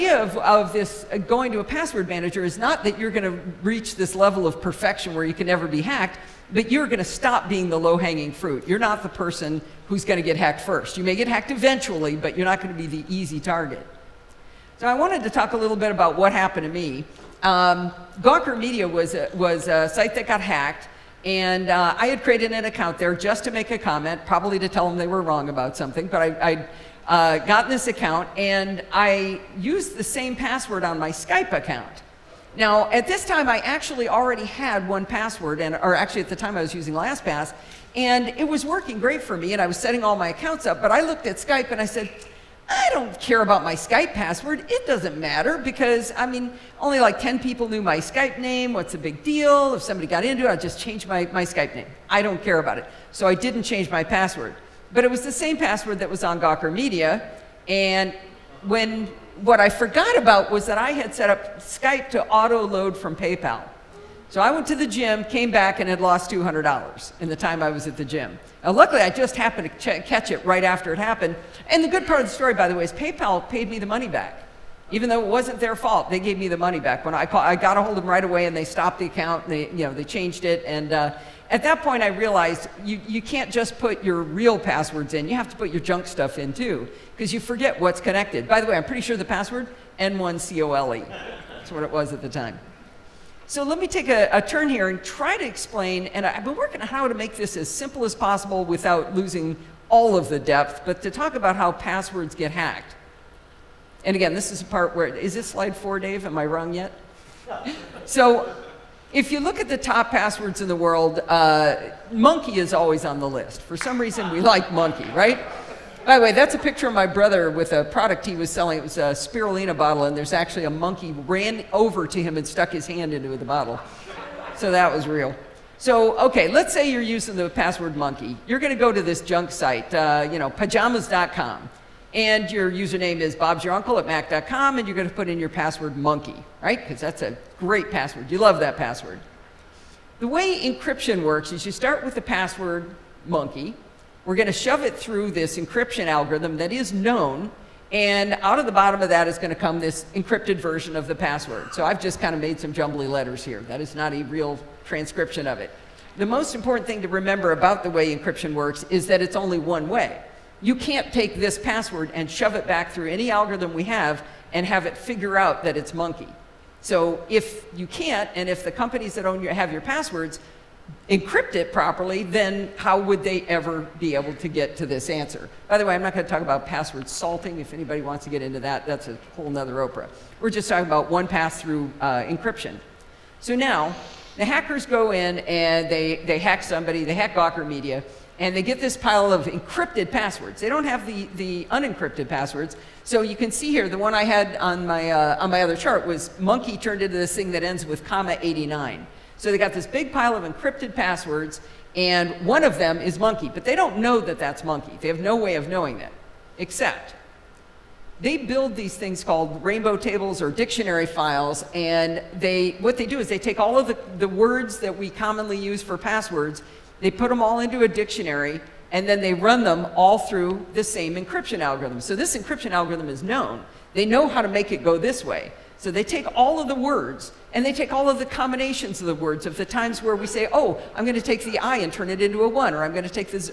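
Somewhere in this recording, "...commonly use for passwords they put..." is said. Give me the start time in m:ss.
3:35.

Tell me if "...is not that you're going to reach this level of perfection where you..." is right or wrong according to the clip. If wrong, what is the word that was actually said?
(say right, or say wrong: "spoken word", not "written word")
right.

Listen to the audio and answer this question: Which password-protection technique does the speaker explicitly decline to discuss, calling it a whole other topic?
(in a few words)
password salting.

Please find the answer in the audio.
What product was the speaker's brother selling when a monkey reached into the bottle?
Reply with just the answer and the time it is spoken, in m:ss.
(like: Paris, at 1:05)
spirulina, at 1:59.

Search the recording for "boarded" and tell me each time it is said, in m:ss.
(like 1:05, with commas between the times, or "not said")
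not said.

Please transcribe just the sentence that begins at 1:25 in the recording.
You have to put your junk stuff in too, because you forget what's connected.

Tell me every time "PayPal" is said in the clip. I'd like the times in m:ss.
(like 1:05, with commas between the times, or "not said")
1:03, 1:12.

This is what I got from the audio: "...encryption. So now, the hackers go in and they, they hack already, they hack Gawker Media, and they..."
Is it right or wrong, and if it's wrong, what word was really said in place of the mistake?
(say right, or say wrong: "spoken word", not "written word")
wrong: "somebody", not "already".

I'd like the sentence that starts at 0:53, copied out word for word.
So I didn't change my password.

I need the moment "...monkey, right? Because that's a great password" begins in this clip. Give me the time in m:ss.
2:15.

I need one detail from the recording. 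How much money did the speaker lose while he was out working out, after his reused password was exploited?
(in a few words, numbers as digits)
$200.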